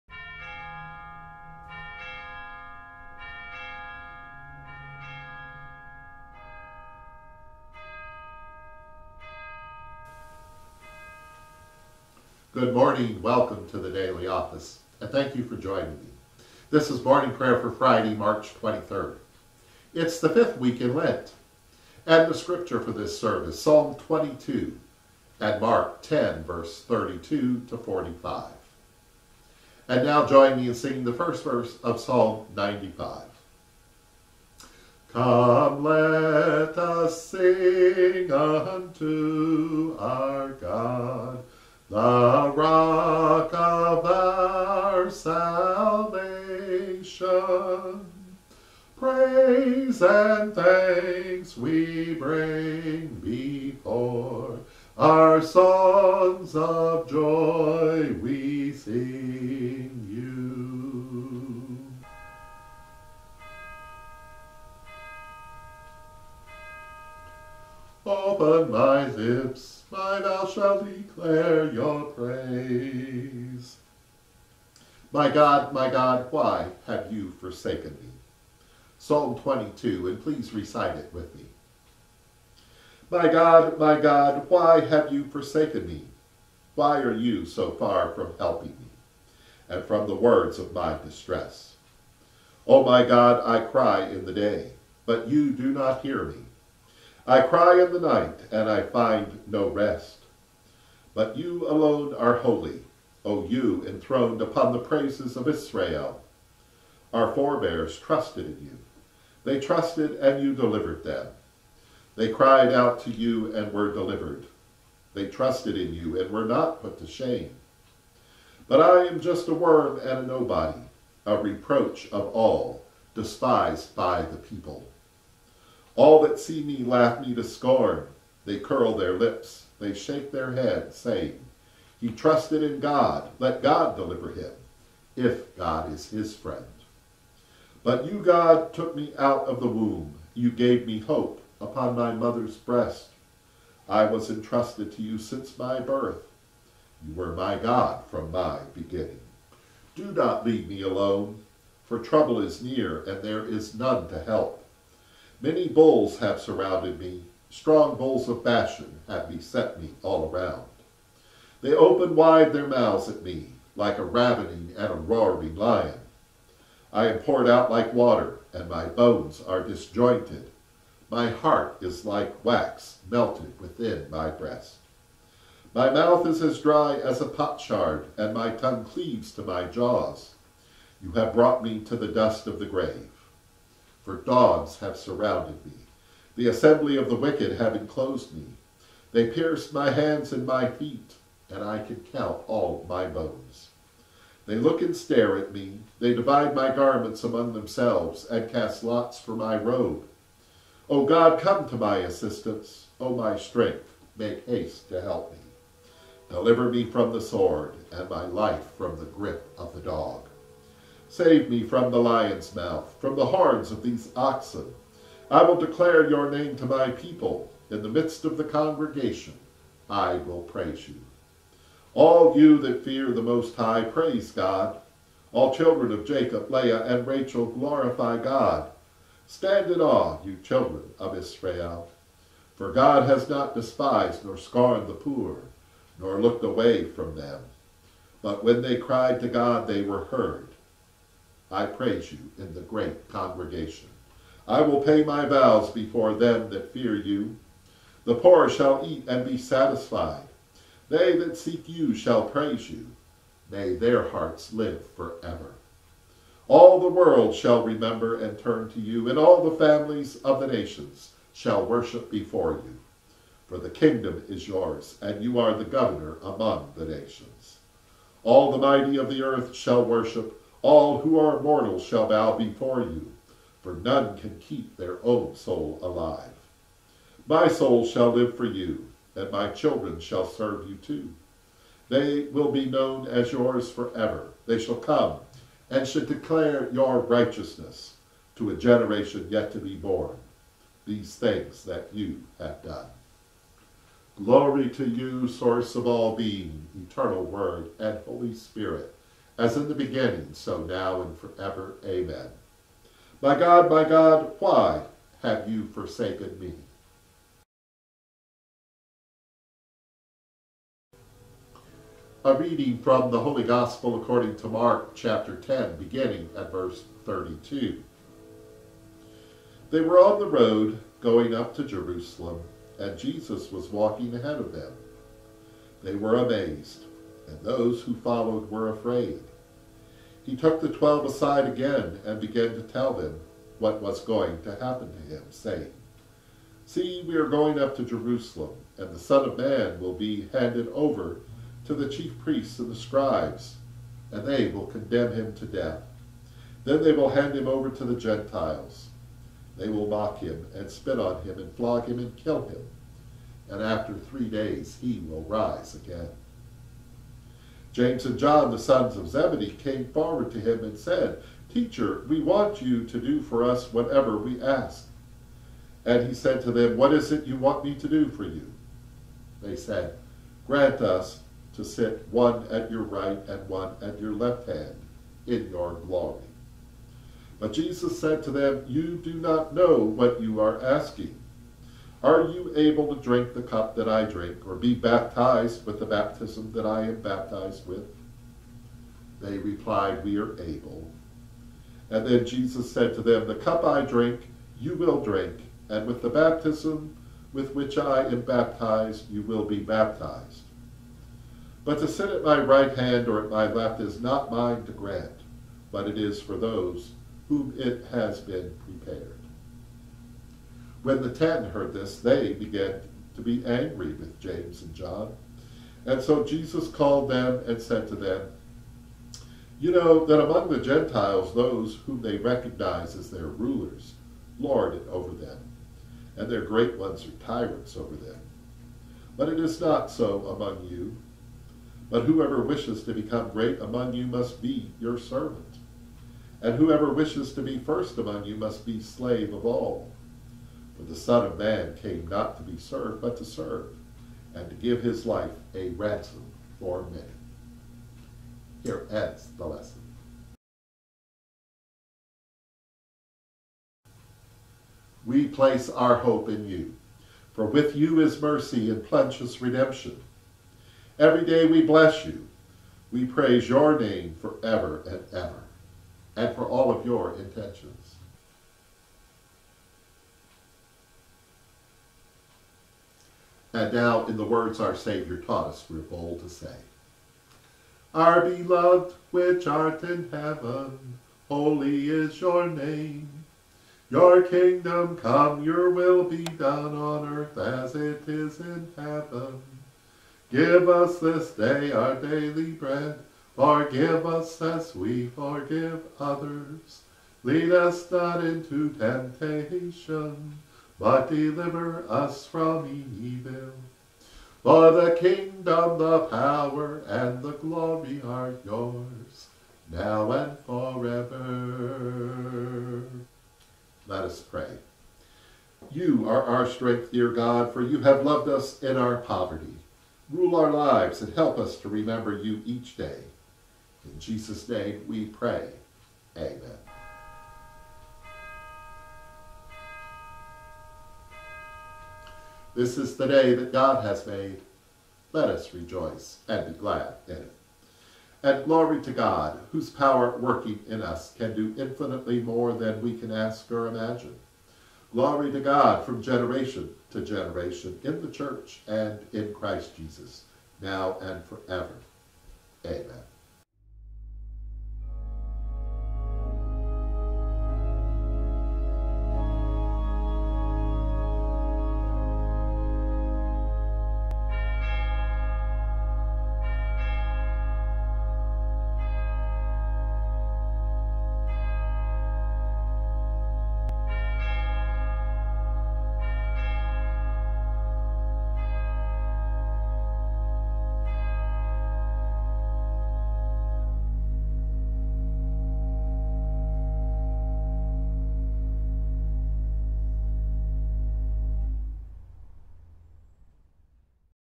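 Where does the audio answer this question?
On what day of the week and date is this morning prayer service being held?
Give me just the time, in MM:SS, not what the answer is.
00:17.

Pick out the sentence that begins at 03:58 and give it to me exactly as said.
But when they cried to God, they were heard.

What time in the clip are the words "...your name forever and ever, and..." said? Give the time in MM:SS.
07:43.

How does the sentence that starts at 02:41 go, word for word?
They open wide their mouths at me, like a ravening and a roaring lion.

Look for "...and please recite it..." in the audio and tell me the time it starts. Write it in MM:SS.
01:20.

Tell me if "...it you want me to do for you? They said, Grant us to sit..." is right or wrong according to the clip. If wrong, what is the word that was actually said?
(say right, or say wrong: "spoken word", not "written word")
right.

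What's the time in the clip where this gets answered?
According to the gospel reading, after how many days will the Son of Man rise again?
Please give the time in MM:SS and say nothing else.
05:53.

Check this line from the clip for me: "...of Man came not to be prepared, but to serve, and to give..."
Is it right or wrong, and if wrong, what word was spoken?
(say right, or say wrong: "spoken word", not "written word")
wrong: "served", not "prepared".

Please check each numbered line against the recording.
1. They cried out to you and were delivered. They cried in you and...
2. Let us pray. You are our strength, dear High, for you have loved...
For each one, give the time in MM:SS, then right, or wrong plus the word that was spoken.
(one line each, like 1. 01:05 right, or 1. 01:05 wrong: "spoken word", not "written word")
1. 01:52 wrong: "trusted", not "cried"
2. 08:33 wrong: "God", not "High".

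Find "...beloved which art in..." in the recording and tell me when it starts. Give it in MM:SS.
07:58.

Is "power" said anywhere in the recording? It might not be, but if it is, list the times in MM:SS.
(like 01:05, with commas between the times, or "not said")
08:26, 08:59.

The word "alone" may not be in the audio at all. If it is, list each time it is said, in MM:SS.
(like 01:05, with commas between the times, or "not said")
01:41, 02:30.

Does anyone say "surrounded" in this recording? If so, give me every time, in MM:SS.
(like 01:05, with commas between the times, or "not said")
02:36, 03:04.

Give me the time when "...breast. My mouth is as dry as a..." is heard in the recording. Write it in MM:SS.
02:54.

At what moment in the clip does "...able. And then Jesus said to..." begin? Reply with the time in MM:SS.
06:30.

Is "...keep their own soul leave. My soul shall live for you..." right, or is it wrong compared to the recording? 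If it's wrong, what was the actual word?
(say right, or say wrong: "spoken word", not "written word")
wrong: "alive", not "leave".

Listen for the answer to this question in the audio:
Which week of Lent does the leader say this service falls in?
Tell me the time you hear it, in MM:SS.
00:20.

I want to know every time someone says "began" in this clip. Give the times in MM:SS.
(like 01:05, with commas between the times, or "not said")
05:32, 06:52.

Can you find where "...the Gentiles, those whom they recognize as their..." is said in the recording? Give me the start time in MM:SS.
07:00.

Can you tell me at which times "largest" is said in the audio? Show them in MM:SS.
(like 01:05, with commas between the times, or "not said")
not said.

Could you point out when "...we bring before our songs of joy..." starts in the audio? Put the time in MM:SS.
00:51.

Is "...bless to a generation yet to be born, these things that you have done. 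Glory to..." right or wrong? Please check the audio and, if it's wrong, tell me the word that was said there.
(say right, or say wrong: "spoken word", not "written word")
wrong: "righteousness", not "bless".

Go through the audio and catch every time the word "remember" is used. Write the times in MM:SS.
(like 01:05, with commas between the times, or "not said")
04:17, 08:41.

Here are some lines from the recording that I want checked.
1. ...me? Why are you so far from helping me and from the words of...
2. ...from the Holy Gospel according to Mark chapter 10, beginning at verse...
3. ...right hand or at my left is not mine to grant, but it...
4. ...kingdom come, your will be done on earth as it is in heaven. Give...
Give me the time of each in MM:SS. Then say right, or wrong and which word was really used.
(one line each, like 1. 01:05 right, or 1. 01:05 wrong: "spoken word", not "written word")
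1. 01:25 right
2. 05:12 right
3. 06:42 right
4. 08:04 right.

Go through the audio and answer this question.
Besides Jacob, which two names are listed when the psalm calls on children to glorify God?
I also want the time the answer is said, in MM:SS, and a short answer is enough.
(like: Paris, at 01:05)
Leah and Rachel, at 03:46.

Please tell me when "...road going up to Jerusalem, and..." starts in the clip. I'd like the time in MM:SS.
05:20.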